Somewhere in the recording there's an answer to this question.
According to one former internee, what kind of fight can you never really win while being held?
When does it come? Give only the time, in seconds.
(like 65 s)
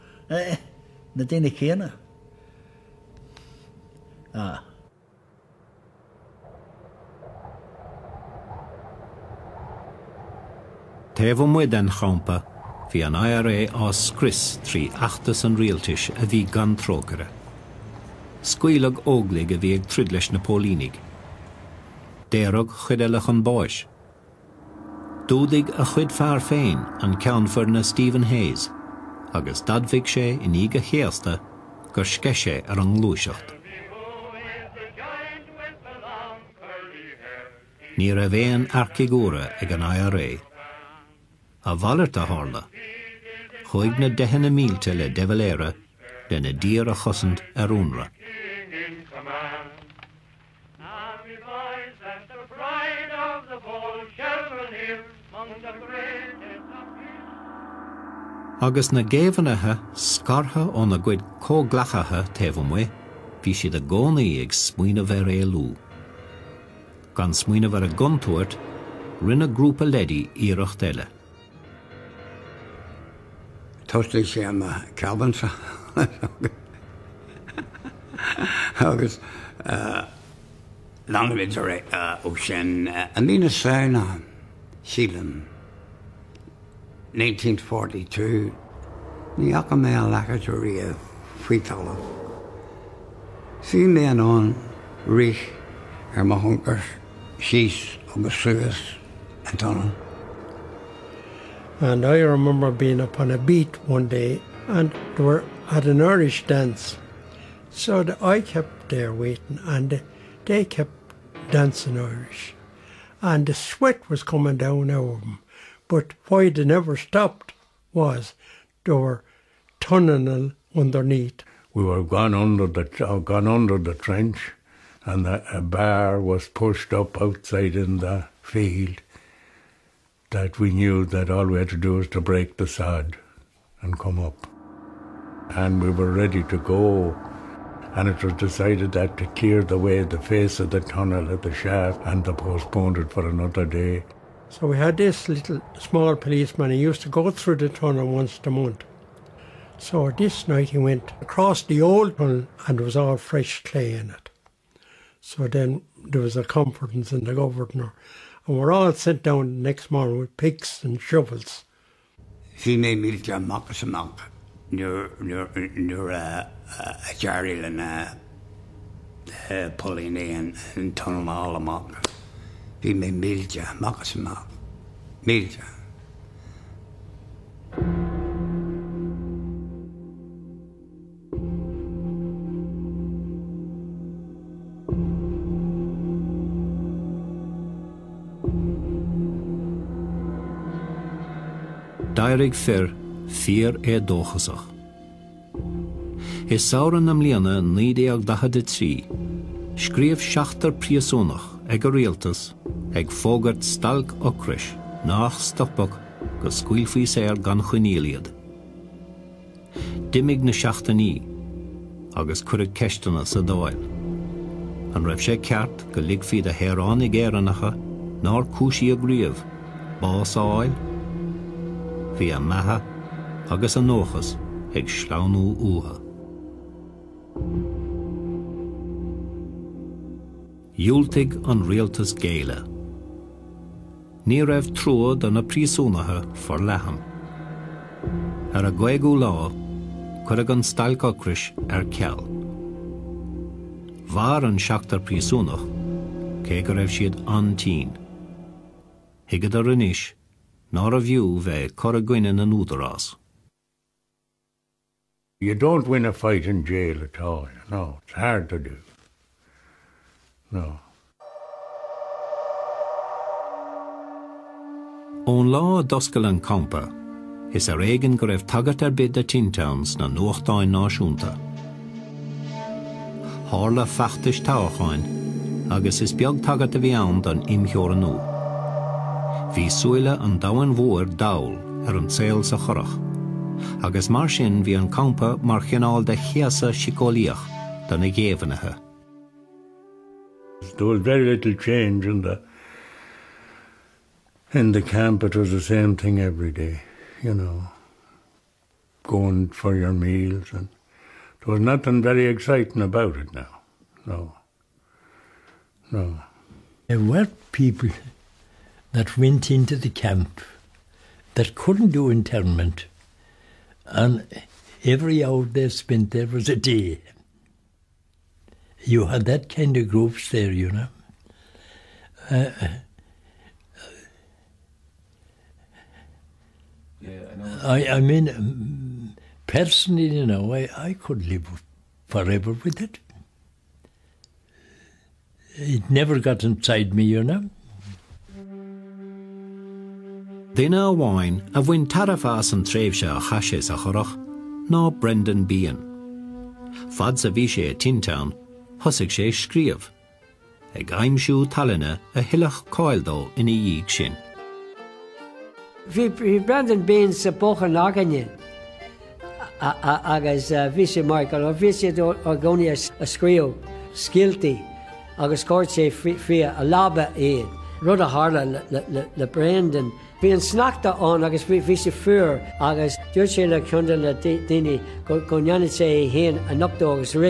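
256 s.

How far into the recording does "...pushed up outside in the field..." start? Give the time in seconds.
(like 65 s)
126 s.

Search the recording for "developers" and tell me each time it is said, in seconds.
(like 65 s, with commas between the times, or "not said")
not said.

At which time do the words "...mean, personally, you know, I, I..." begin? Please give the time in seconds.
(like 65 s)
328 s.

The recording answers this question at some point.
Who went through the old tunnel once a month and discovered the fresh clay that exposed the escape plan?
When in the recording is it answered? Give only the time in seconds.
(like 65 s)
145 s.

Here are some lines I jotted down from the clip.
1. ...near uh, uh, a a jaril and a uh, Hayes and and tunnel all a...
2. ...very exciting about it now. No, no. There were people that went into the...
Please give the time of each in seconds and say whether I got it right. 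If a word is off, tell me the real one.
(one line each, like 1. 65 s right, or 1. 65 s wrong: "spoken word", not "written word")
1. 165 s wrong: "Pauline", not "Hayes"
2. 302 s right.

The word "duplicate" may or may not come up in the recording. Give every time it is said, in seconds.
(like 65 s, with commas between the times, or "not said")
not said.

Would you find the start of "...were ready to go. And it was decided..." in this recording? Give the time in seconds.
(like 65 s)
135 s.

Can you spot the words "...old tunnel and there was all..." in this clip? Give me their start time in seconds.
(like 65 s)
151 s.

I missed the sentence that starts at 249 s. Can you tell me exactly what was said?
Hiigad a rinis ná a bhiú bheith chu a gcuine an údarrás.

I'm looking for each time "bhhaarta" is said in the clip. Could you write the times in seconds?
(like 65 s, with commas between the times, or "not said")
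41 s.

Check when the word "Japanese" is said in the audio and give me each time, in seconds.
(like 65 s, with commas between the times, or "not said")
not said.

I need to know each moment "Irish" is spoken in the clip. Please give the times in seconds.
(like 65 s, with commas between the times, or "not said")
106 s, 111 s.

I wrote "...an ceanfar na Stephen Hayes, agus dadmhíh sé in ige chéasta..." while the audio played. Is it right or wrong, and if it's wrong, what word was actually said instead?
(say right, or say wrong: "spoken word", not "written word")
right.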